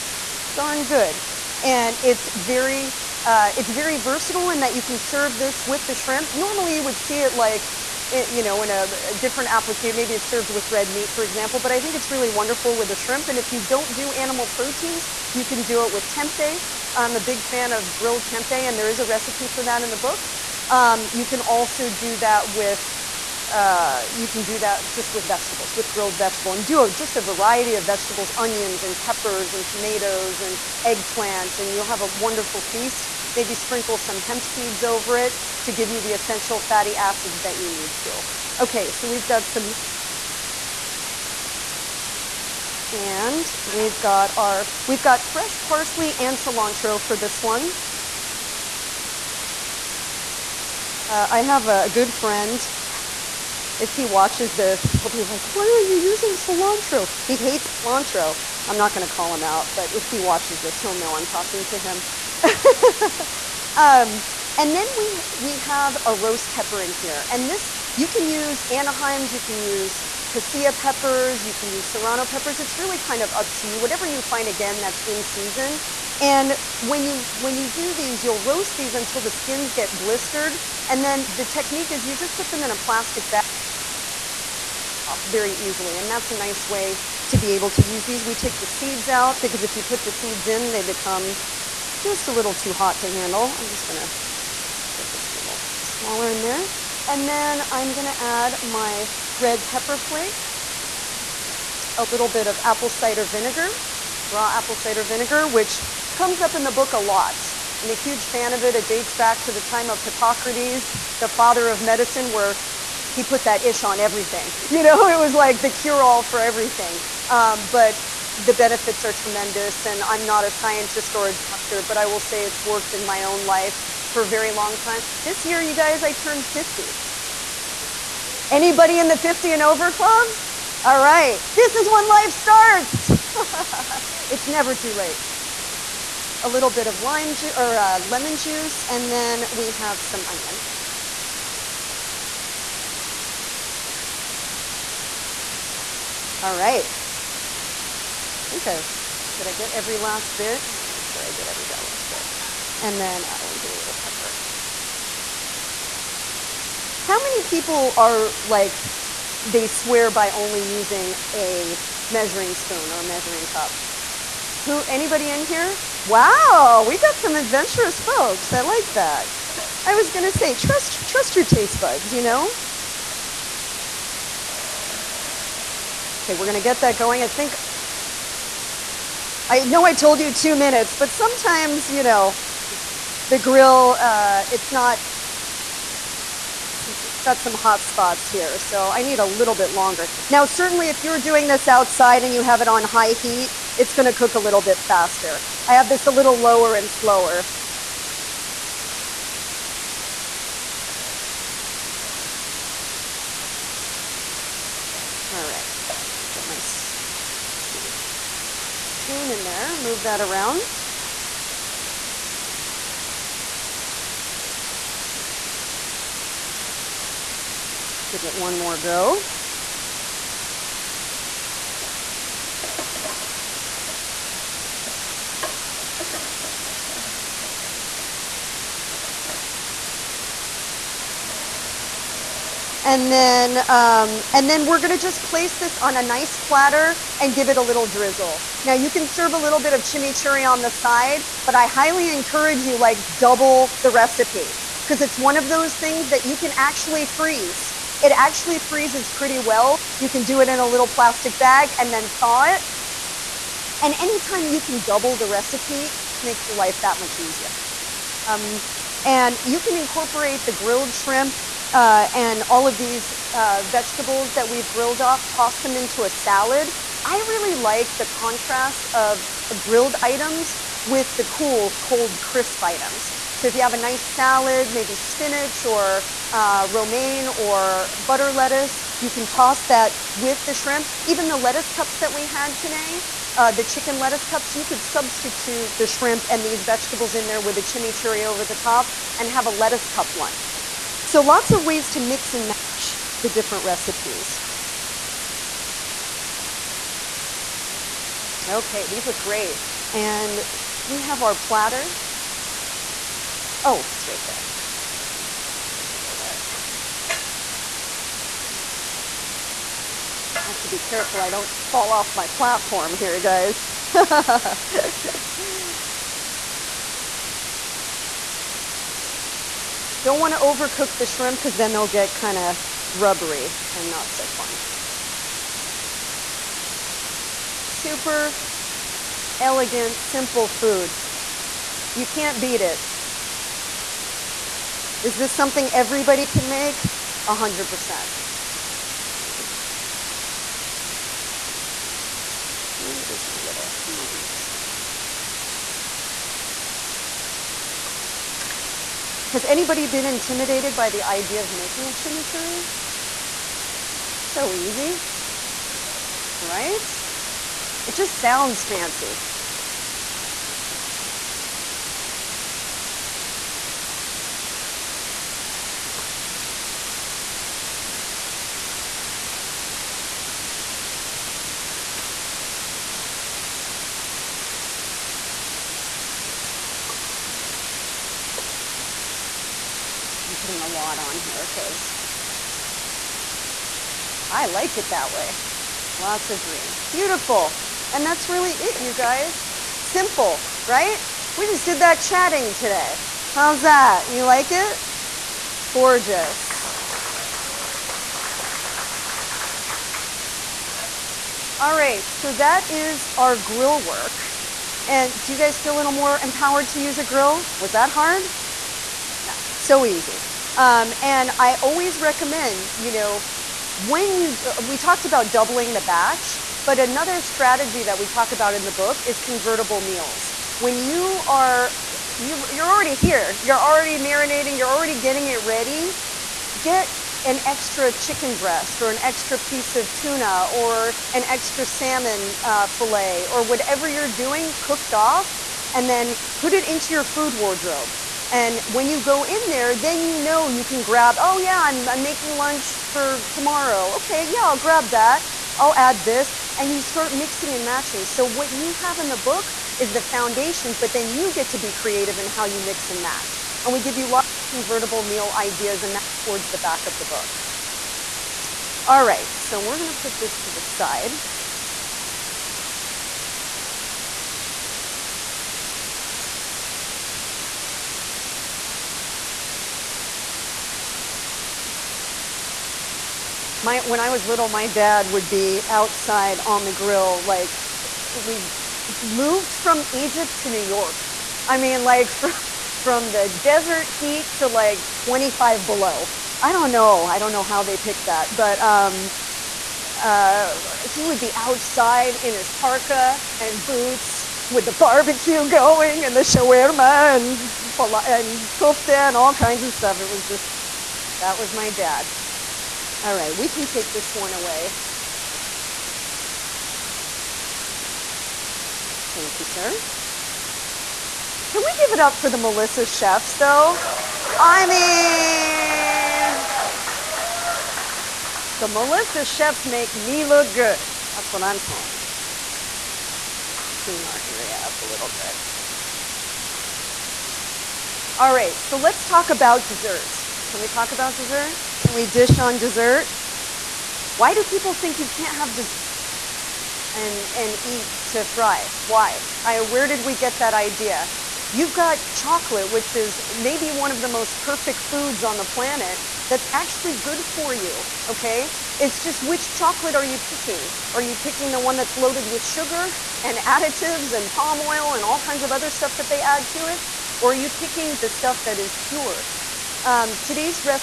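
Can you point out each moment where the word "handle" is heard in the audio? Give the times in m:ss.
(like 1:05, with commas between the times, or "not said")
1:33.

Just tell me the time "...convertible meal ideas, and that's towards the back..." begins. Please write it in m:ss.
7:34.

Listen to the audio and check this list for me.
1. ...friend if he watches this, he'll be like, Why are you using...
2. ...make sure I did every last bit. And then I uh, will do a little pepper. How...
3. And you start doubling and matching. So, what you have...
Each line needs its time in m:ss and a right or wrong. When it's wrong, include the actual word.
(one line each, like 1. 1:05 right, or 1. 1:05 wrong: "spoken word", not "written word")
1. 0:52 right
2. 2:30 right
3. 7:26 wrong: "mixing", not "doubling".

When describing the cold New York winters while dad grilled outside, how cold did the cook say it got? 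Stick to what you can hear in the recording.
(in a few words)
25 below.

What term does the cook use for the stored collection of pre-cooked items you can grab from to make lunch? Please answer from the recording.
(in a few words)
food wardrobe.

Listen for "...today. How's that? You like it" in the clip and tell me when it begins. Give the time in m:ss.
6:32.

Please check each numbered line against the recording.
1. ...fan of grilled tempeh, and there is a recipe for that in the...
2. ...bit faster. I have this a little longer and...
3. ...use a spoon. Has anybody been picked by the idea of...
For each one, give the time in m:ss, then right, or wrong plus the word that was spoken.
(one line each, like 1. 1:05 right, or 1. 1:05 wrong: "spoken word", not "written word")
1. 0:17 right
2. 3:14 wrong: "lower", not "longer"
3. 5:44 wrong: "intimidated", not "picked".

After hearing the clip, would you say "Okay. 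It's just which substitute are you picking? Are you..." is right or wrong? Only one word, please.
wrong.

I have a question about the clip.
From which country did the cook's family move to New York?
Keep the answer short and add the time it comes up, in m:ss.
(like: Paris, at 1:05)
Egypt, at 7:59.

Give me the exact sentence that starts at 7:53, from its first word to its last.
my when I was little, my dad would be outside on the grill.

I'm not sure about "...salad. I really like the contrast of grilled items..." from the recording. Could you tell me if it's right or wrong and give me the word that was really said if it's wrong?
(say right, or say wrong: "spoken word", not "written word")
right.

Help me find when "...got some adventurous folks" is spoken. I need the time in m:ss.
2:46.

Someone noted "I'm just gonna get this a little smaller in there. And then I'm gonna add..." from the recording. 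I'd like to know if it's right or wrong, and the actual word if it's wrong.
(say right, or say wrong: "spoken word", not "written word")
right.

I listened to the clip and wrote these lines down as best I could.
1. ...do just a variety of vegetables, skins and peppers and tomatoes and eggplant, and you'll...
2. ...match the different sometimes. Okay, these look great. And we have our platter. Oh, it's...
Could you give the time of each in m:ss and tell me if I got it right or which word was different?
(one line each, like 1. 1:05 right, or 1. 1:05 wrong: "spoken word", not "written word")
1. 0:26 wrong: "onions", not "skins"
2. 4:52 wrong: "recipes", not "sometimes".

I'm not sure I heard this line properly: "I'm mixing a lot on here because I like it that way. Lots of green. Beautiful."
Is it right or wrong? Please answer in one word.
wrong.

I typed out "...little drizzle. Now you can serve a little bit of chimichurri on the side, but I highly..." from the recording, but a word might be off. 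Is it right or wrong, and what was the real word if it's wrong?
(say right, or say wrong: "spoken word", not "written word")
right.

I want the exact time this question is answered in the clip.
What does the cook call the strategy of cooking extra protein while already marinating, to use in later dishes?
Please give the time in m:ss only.
6:59.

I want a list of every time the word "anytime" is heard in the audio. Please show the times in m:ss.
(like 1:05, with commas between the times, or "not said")
4:13.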